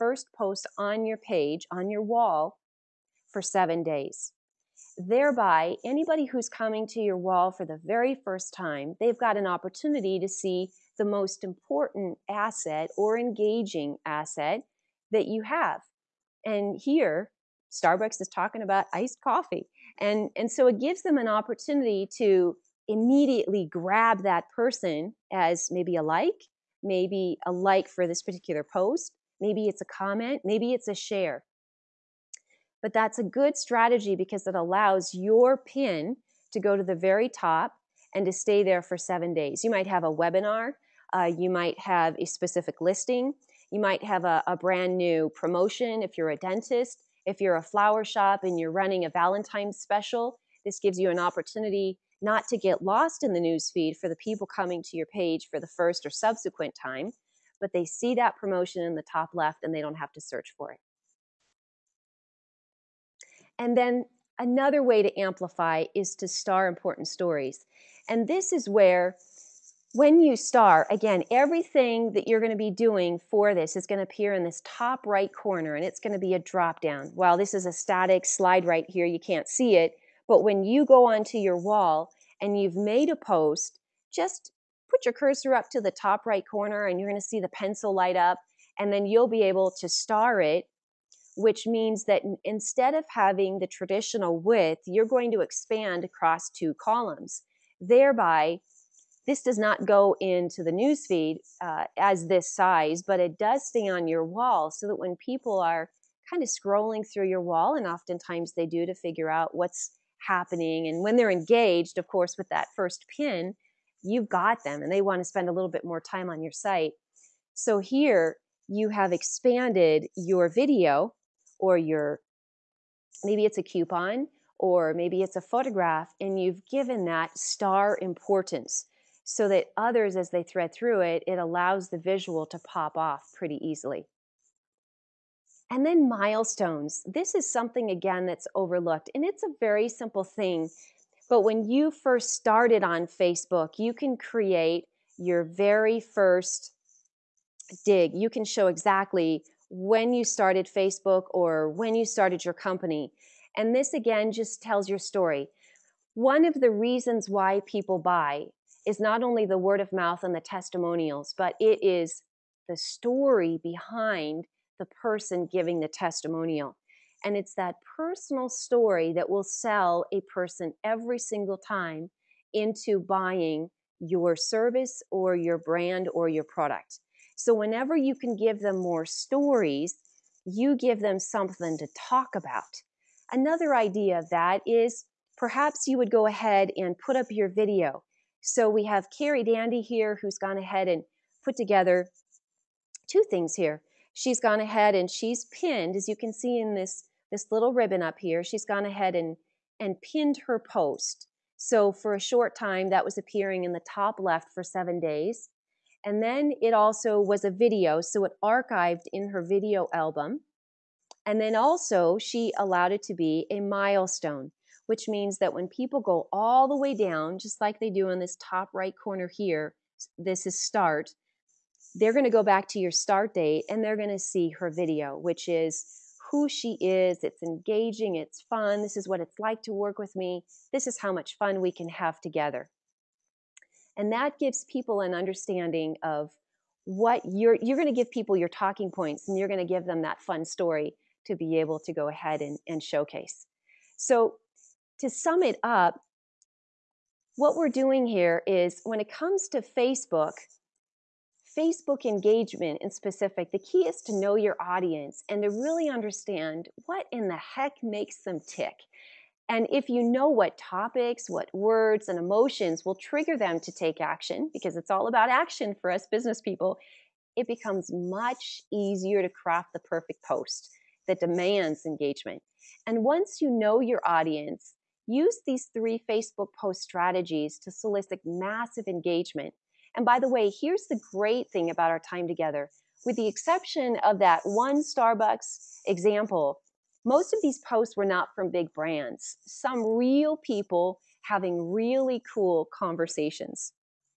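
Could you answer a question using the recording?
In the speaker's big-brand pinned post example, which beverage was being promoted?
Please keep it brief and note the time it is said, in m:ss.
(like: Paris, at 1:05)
Iced coffee, at 0:18.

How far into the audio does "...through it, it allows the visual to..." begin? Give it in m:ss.
2:10.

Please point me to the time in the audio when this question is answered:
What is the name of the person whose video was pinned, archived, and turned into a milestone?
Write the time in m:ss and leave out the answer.
3:09.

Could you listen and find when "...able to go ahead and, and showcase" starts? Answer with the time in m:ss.
4:01.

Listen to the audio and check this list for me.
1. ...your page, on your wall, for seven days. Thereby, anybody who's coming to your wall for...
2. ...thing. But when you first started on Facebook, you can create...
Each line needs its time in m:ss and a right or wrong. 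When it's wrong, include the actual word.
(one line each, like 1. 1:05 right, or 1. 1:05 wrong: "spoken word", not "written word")
1. 0:01 right
2. 2:20 right.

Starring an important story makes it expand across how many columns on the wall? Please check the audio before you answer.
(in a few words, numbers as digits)
2.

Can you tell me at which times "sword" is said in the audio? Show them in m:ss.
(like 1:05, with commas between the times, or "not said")
not said.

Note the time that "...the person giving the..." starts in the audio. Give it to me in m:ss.
2:44.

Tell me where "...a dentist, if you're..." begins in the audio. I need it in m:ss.
0:46.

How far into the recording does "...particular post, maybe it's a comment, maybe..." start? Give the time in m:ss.
0:28.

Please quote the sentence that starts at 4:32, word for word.
And once you know your audience, Use these three Facebook post strategies to solicit massive engagement.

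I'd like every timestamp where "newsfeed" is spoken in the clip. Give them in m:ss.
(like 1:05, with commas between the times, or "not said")
0:53, 1:40.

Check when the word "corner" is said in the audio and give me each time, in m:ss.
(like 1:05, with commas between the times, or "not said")
1:15, 1:26, 3:39.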